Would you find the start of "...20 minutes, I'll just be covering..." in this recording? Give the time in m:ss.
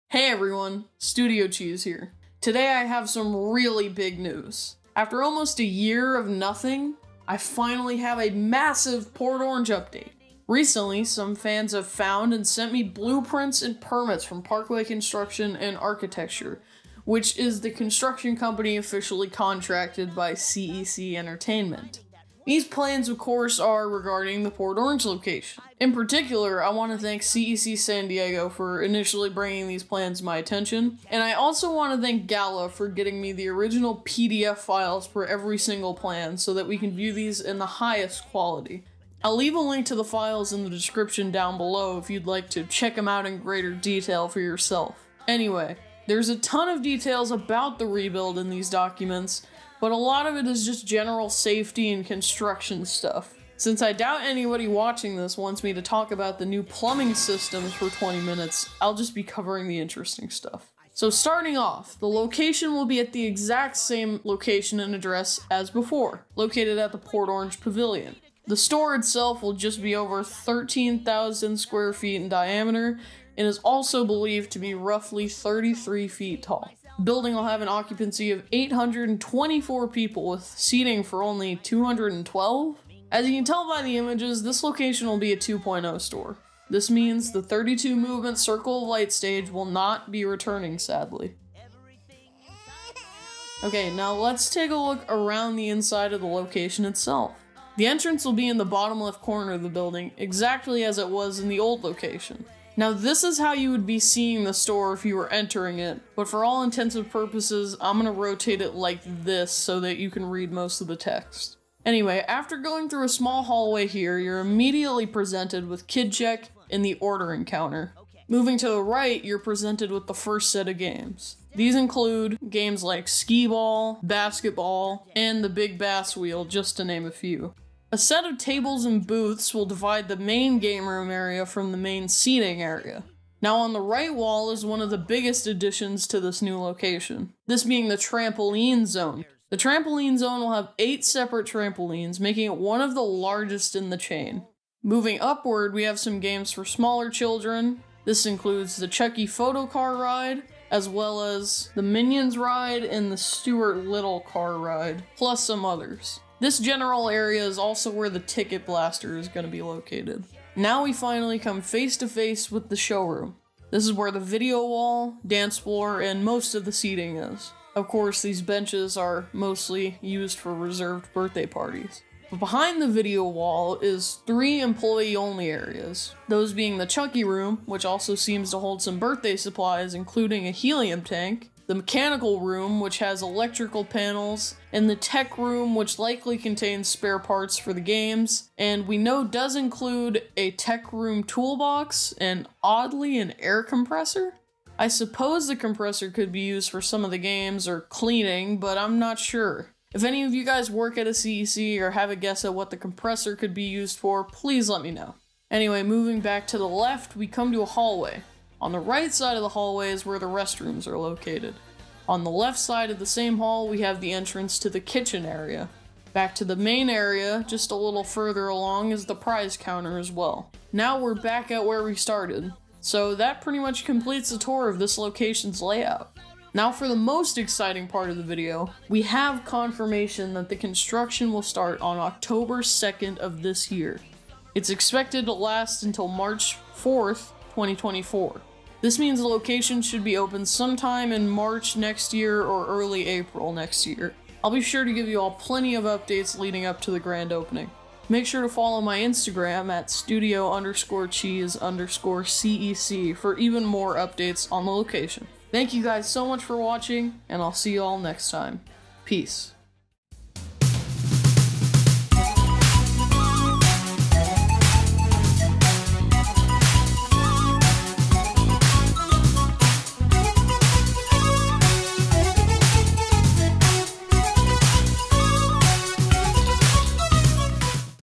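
0:57.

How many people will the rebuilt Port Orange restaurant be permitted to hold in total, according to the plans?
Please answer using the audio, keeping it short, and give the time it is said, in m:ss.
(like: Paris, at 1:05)
824, at 1:18.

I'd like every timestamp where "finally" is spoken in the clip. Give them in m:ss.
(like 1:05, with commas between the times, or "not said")
0:07, 2:40.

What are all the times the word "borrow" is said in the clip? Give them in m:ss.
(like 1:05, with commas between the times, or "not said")
not said.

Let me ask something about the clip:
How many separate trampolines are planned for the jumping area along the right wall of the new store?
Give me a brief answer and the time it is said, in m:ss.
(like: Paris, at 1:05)
8, at 2:20.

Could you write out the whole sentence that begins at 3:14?
I suppose the compressor could be used for some of the games or cleaning, but I'm not sure.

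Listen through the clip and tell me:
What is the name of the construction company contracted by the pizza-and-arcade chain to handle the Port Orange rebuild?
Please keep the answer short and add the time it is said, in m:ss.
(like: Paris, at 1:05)
Parkway Construction and Architecture, at 0:14.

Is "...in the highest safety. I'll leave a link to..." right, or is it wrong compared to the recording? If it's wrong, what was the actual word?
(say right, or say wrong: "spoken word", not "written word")
wrong: "quality", not "safety".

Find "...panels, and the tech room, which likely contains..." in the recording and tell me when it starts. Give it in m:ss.
3:03.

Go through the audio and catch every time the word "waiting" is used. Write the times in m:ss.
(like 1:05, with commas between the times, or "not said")
not said.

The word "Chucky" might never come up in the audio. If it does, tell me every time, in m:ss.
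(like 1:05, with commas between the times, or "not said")
2:28, 2:56.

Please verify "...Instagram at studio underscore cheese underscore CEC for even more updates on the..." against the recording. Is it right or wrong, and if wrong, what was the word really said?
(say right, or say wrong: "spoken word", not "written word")
right.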